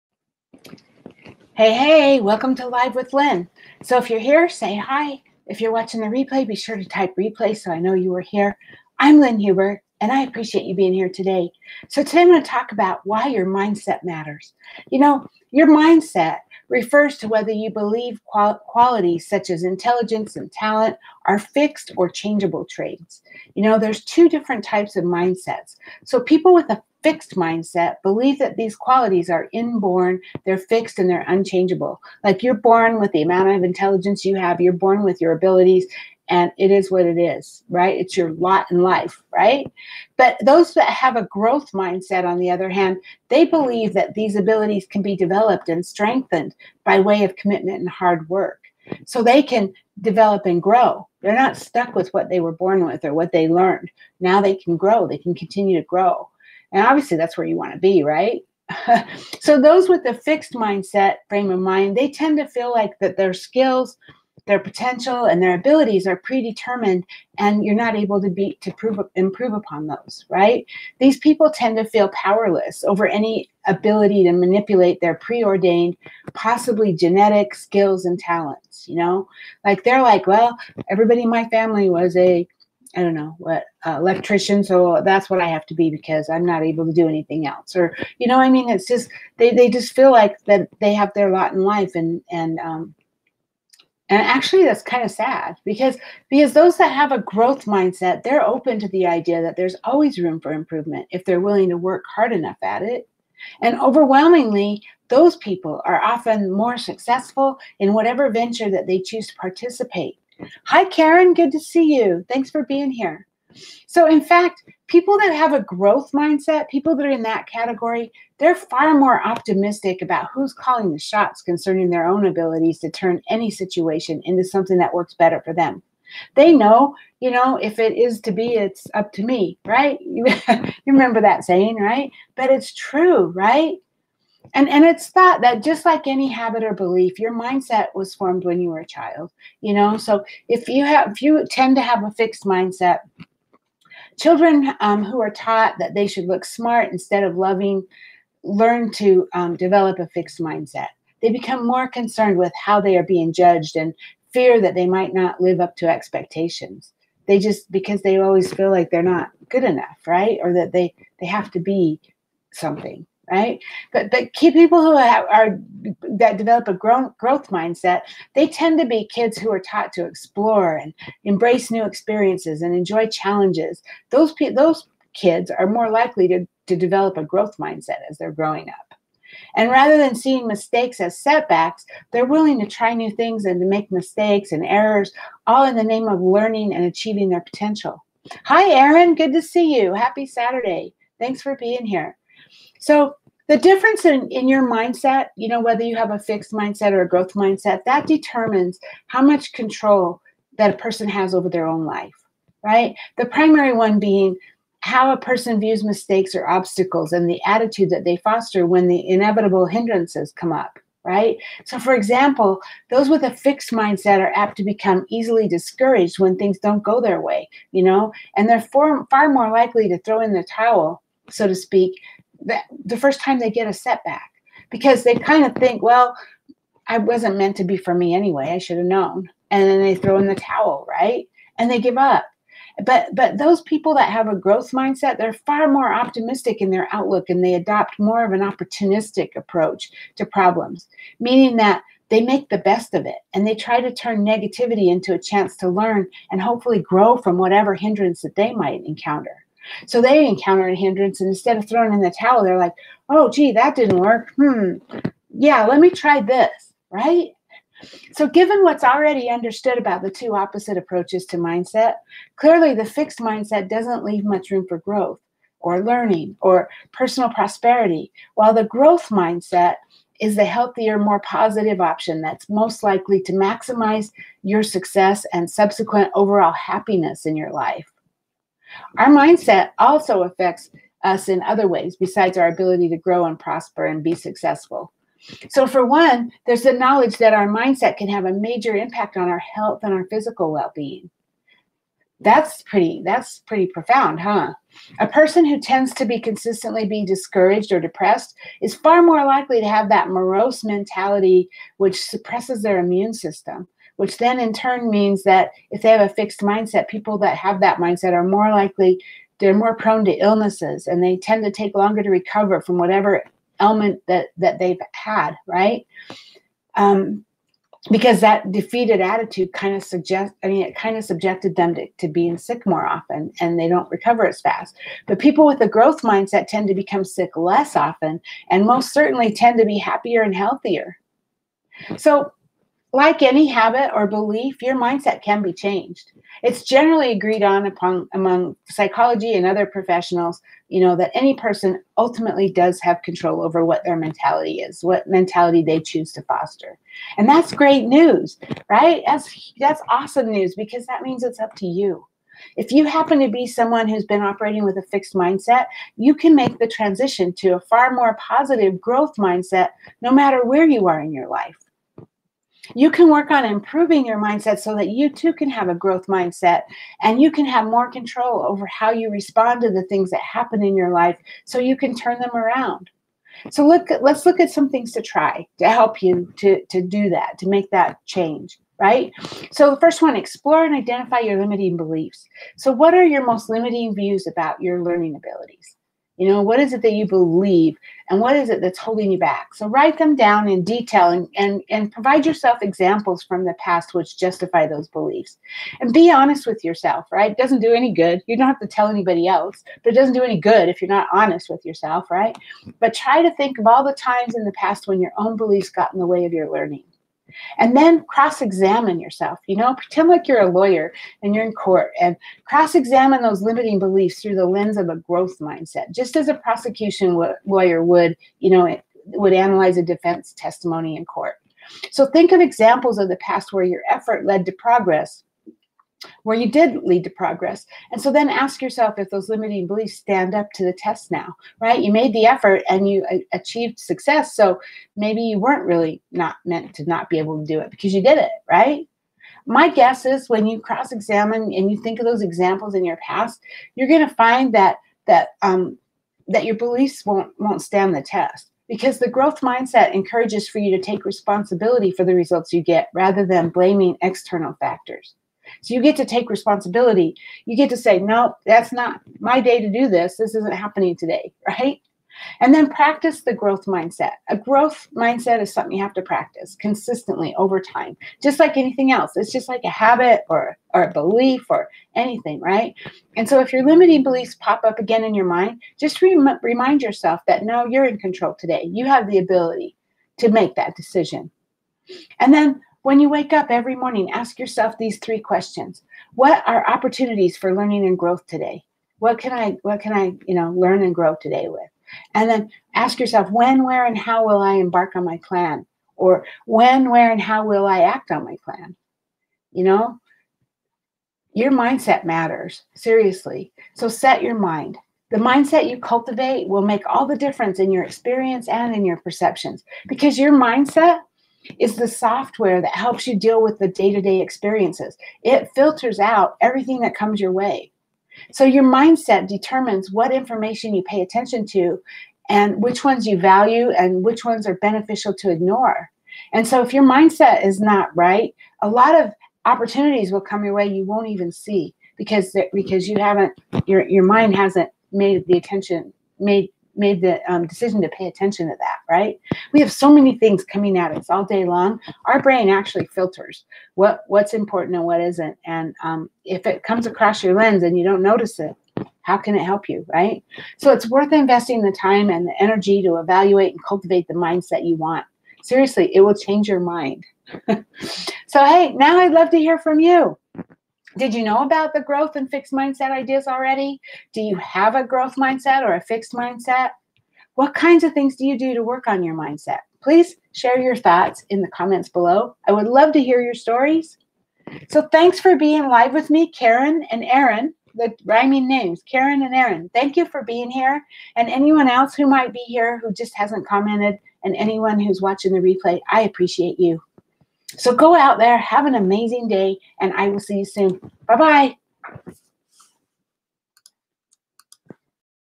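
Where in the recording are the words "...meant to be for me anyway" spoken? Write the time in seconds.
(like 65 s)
227 s.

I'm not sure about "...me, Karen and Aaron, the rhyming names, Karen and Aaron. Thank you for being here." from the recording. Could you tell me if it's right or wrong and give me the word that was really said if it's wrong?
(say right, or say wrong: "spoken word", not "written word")
right.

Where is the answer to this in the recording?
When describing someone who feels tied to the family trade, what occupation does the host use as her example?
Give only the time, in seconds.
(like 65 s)
83 s.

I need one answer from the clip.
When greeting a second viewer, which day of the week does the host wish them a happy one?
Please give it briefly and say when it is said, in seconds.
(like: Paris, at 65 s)
Saturday, at 190 s.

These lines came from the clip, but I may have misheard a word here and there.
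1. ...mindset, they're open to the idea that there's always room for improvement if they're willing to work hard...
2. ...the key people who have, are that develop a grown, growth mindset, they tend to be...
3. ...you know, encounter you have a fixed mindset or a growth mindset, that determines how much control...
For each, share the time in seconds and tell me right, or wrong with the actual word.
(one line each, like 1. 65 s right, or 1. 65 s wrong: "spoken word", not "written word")
1. 97 s right
2. 164 s right
3. 195 s wrong: "whether", not "encounter".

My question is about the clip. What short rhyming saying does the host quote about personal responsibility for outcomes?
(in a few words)
If it is to be, it's up to me.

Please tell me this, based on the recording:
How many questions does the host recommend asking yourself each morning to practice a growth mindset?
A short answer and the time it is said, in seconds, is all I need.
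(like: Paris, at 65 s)
3, at 484 s.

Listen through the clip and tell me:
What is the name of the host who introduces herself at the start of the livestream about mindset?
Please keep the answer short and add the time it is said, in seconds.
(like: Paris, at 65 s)
Lynn Huber, at 9 s.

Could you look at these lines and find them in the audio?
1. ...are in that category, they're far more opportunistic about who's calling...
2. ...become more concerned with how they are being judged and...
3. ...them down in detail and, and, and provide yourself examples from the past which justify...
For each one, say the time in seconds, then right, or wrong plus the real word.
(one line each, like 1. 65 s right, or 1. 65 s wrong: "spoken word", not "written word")
1. 117 s wrong: "optimistic", not "opportunistic"
2. 151 s right
3. 389 s right.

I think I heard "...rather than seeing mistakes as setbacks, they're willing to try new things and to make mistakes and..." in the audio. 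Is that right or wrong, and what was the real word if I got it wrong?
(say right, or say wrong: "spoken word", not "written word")
right.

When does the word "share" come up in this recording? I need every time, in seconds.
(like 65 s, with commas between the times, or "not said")
570 s.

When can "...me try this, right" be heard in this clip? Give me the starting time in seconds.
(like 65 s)
255 s.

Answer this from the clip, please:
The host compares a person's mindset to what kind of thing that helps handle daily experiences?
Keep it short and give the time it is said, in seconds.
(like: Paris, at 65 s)
software, at 511 s.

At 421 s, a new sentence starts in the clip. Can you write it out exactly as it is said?
So think of examples of the past where your effort led to progress where you did lead to progress.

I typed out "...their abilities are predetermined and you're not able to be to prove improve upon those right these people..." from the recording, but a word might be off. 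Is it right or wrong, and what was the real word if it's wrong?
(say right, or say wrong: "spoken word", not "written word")
right.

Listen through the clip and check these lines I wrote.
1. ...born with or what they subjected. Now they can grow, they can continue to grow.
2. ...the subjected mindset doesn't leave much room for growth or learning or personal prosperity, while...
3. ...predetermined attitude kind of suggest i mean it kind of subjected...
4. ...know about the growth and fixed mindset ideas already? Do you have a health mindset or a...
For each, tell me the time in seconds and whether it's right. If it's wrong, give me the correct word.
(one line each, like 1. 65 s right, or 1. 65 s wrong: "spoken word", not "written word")
1. 52 s wrong: "learned", not "subjected"
2. 262 s wrong: "fixed", not "subjected"
3. 318 s wrong: "defeated", not "predetermined"
4. 561 s wrong: "growth", not "health".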